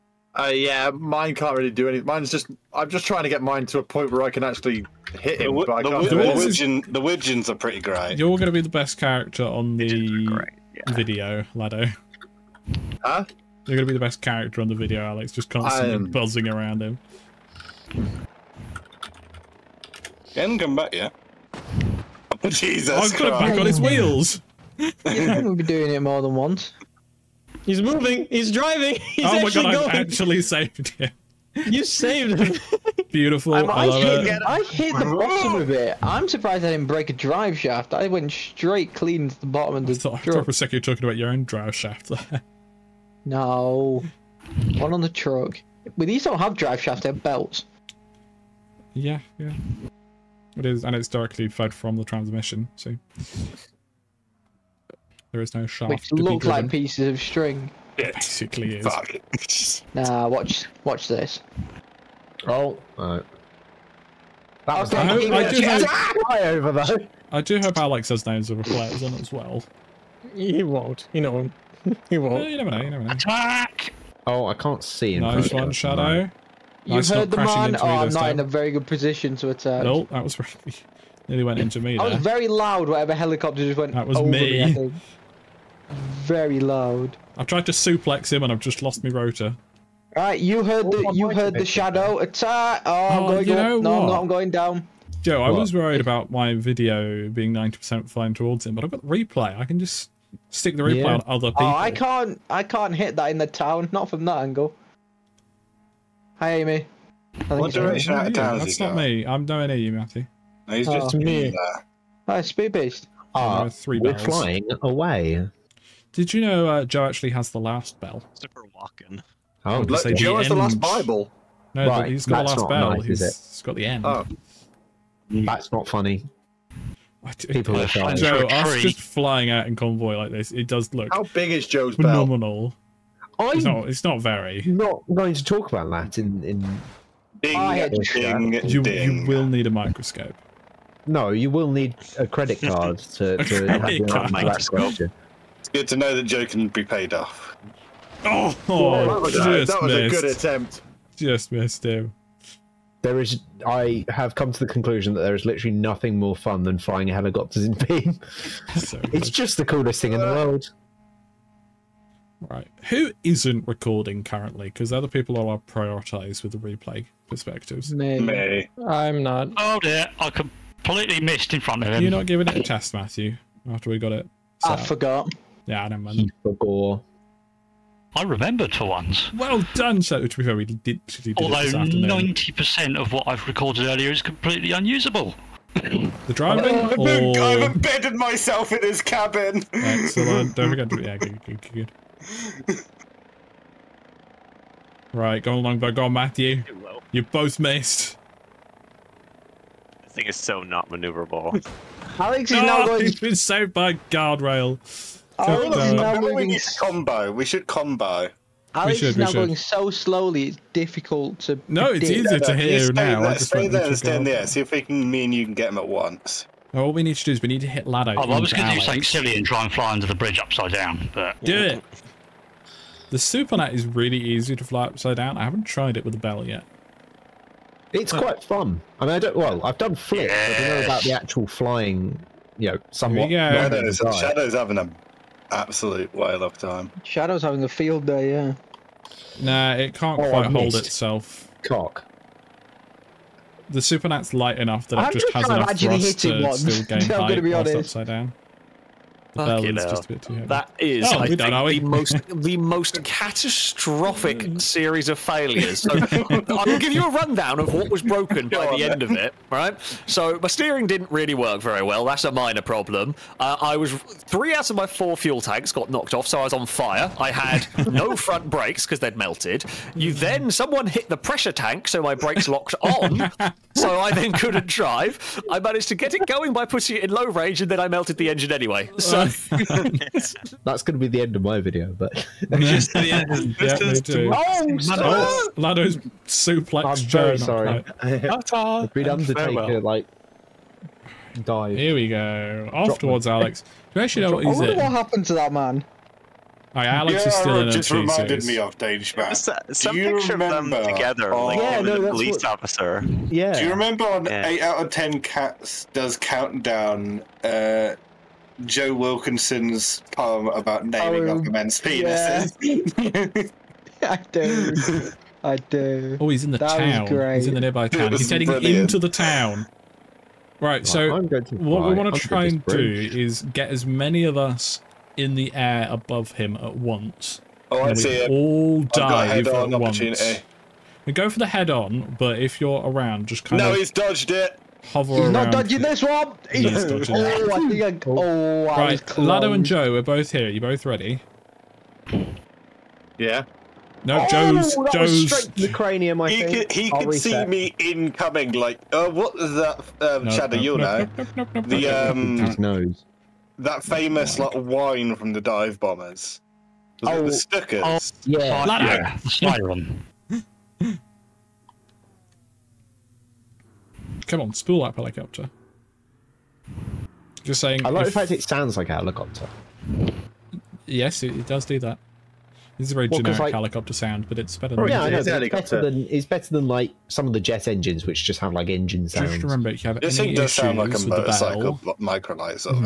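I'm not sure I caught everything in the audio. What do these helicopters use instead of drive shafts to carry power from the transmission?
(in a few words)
belts.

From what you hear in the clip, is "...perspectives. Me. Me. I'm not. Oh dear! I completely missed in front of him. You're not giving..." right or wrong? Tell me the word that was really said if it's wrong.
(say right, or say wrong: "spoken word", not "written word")
right.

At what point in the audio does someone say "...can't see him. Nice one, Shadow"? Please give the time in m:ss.
1:14.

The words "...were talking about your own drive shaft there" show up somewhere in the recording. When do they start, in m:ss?
0:40.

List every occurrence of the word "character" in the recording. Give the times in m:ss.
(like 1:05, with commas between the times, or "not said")
0:08, 0:14.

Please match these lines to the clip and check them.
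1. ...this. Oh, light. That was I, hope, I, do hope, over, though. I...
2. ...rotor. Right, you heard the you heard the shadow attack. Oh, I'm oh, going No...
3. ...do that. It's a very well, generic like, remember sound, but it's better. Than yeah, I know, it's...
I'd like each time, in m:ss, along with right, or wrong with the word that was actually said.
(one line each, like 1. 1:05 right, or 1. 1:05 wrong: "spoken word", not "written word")
1. 1:01 wrong: "alright", not "light"
2. 1:29 right
3. 6:11 wrong: "helicopter", not "remember".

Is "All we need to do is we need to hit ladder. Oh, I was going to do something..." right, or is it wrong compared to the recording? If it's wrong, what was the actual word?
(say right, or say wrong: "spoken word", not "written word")
right.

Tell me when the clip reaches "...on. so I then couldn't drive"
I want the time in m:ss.
4:32.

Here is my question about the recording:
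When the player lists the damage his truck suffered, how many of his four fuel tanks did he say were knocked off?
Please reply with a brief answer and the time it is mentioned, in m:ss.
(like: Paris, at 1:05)
3, at 4:23.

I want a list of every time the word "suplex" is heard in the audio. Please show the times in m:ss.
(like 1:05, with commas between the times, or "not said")
1:27, 4:46.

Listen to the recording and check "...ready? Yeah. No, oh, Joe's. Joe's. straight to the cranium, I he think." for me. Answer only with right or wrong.
right.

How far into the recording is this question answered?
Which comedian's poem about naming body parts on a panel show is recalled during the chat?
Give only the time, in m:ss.
5:08.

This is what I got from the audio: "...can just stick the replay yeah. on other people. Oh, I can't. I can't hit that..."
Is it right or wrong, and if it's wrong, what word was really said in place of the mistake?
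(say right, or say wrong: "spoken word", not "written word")
right.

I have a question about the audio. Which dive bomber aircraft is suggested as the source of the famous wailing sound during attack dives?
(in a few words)
Stukas.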